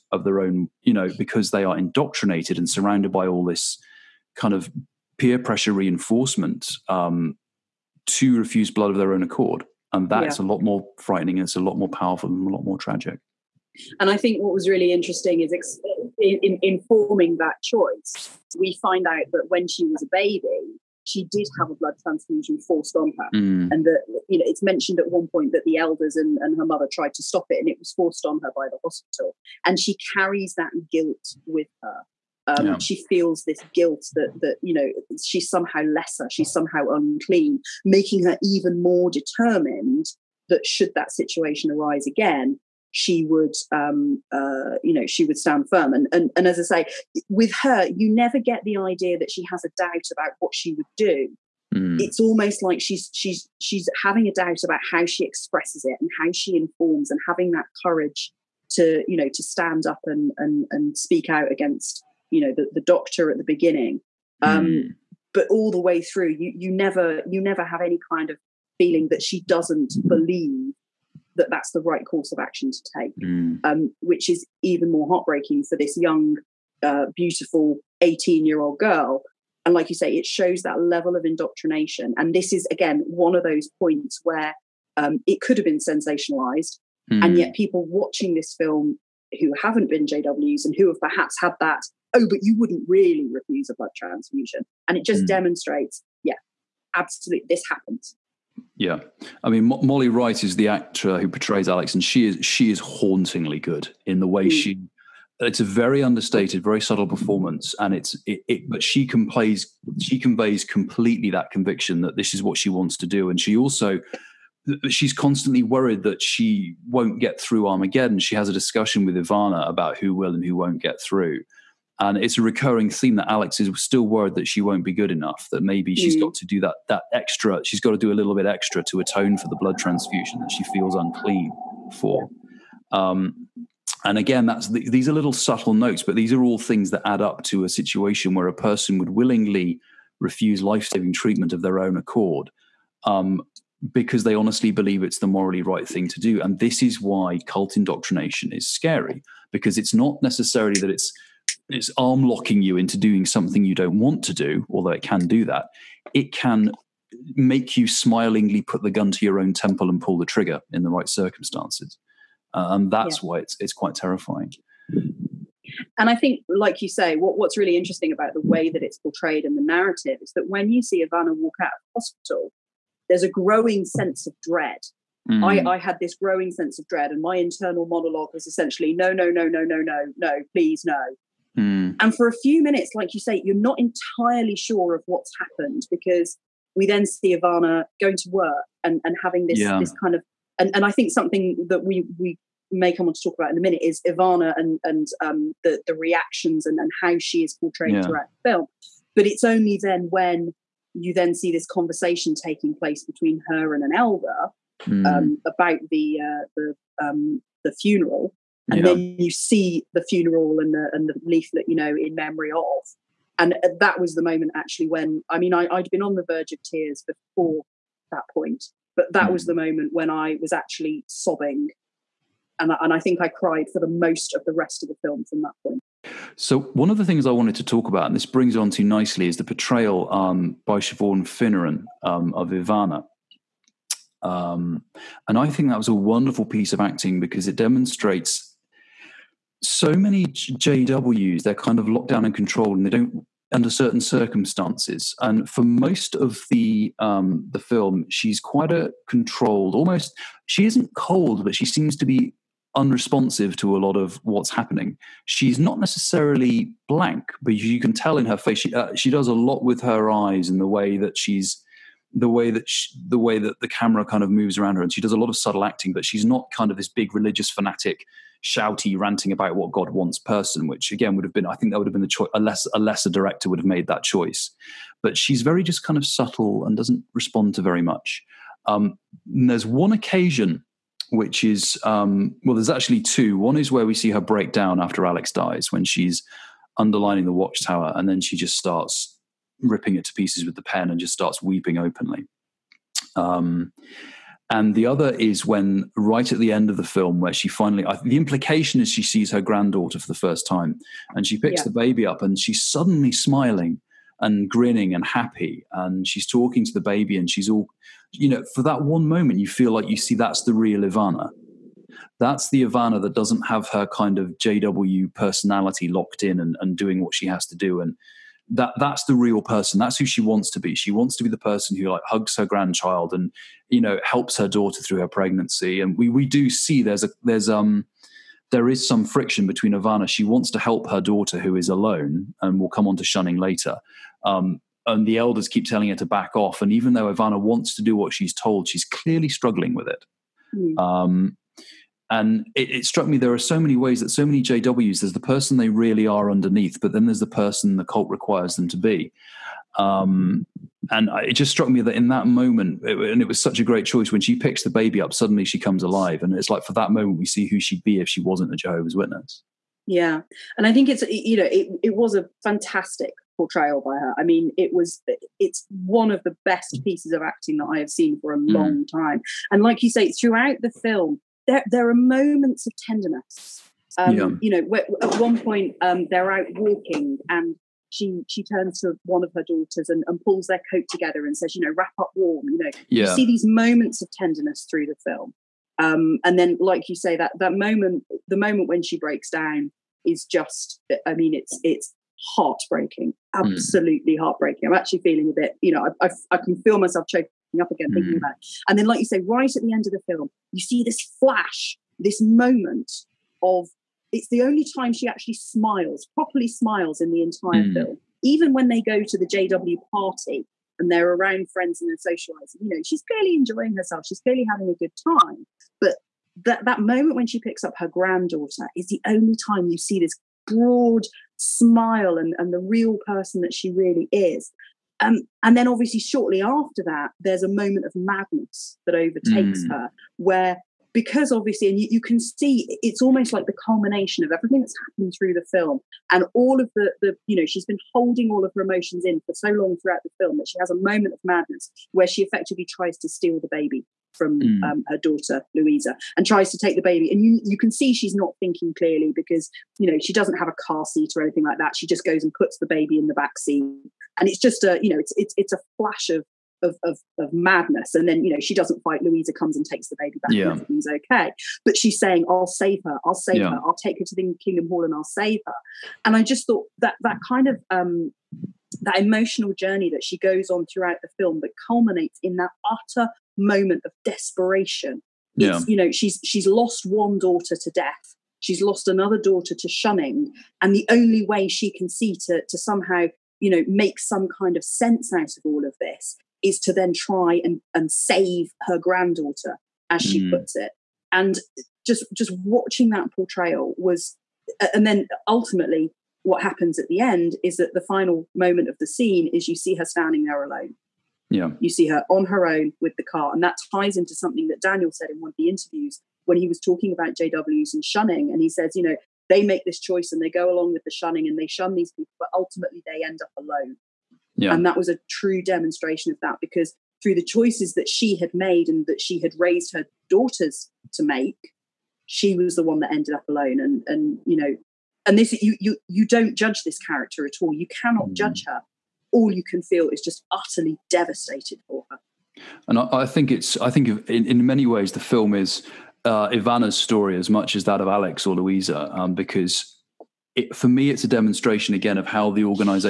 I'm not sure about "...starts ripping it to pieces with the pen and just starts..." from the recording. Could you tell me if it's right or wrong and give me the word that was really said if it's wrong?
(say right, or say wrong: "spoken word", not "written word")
right.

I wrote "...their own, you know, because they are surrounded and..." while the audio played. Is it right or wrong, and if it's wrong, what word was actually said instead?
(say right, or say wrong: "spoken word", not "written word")
wrong: "indoctrinated", not "surrounded".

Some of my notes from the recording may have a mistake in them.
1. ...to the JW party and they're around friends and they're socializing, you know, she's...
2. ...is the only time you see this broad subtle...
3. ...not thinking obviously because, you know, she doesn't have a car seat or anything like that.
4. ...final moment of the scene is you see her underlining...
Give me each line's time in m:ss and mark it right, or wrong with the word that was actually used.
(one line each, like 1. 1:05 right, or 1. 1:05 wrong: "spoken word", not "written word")
1. 6:49 right
2. 6:58 wrong: "smile", not "subtle"
3. 7:28 wrong: "clearly", not "obviously"
4. 8:17 wrong: "standing", not "underlining".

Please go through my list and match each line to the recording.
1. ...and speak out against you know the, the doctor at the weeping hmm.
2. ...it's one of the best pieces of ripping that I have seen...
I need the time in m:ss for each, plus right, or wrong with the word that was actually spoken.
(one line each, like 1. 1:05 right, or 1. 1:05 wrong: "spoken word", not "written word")
1. 1:00 wrong: "beginning", not "weeping"
2. 6:05 wrong: "acting", not "ripping".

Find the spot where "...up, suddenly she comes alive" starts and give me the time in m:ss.
5:55.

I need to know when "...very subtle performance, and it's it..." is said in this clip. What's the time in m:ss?
1:46.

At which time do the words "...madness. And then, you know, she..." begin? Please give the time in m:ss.
7:37.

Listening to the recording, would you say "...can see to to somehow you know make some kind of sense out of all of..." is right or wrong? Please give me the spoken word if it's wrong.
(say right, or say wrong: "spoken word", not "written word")
right.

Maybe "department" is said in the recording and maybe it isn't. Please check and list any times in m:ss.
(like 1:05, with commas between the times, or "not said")
not said.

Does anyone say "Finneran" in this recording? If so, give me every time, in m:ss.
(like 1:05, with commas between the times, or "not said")
3:51.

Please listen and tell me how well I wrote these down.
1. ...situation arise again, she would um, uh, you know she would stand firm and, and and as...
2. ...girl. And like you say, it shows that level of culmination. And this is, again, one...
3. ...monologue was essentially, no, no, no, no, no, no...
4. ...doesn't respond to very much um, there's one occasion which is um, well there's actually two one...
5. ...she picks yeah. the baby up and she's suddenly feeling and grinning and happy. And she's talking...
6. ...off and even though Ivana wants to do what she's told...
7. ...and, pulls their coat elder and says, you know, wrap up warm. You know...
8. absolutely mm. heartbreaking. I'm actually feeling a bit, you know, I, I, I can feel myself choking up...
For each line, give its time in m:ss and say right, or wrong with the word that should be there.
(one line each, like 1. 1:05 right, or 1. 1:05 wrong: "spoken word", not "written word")
1. 0:41 right
2. 1:18 wrong: "indoctrination", not "culmination"
3. 2:57 right
4. 4:36 right
5. 5:01 wrong: "smiling", not "feeling"
6. 5:36 right
7. 6:20 wrong: "together", not "elder"
8. 6:33 right.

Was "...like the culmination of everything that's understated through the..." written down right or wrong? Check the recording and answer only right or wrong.
wrong.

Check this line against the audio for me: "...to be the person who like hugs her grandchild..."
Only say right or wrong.
right.